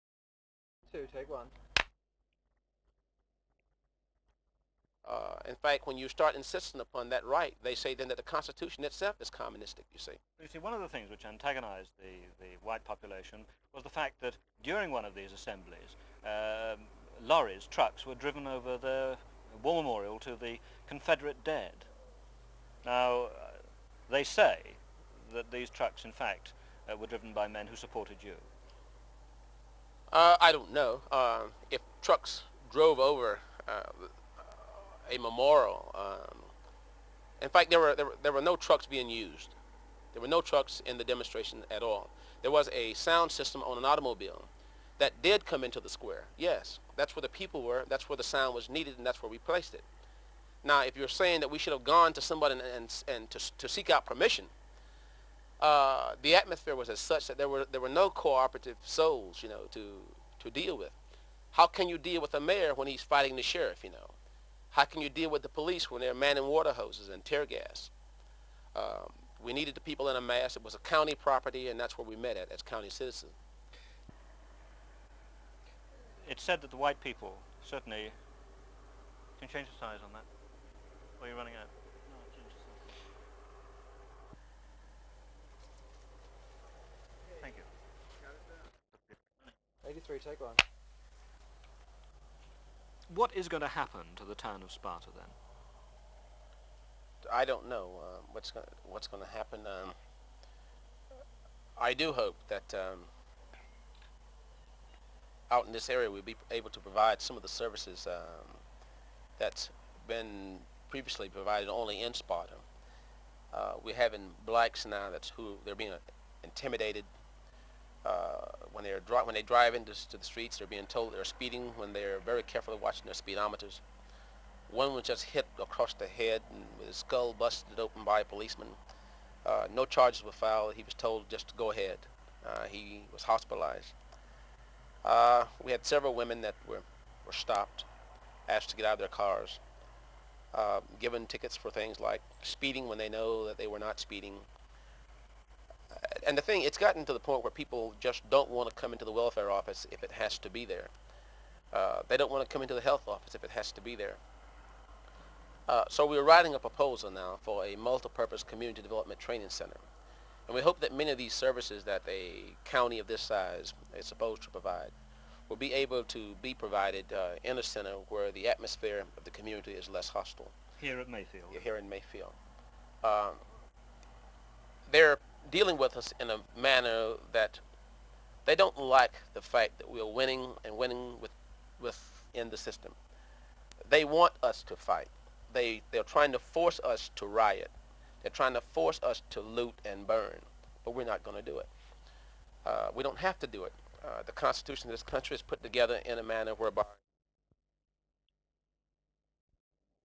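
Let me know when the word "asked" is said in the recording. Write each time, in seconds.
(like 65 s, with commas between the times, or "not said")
138 s.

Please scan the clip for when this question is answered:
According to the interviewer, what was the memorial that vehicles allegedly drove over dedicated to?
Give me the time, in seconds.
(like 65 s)
20 s.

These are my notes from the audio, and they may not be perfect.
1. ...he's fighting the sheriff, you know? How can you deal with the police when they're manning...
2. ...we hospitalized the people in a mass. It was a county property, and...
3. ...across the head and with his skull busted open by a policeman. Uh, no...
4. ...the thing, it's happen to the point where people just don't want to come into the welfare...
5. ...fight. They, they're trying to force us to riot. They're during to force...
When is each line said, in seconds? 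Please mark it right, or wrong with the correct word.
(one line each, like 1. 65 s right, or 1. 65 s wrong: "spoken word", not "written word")
1. 62 s right
2. 69 s wrong: "needed", not "hospitalized"
3. 125 s right
4. 146 s wrong: "gotten", not "happen"
5. 184 s wrong: "trying", not "during".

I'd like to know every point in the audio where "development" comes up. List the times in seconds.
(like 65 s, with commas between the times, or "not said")
158 s.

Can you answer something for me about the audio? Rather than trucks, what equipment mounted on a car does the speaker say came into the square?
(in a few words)
A sound system.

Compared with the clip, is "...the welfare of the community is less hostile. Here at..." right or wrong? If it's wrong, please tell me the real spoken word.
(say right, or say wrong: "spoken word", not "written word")
wrong: "atmosphere", not "welfare".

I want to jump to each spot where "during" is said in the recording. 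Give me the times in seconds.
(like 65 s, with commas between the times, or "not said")
14 s.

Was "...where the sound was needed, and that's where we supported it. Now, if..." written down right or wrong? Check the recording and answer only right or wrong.
wrong.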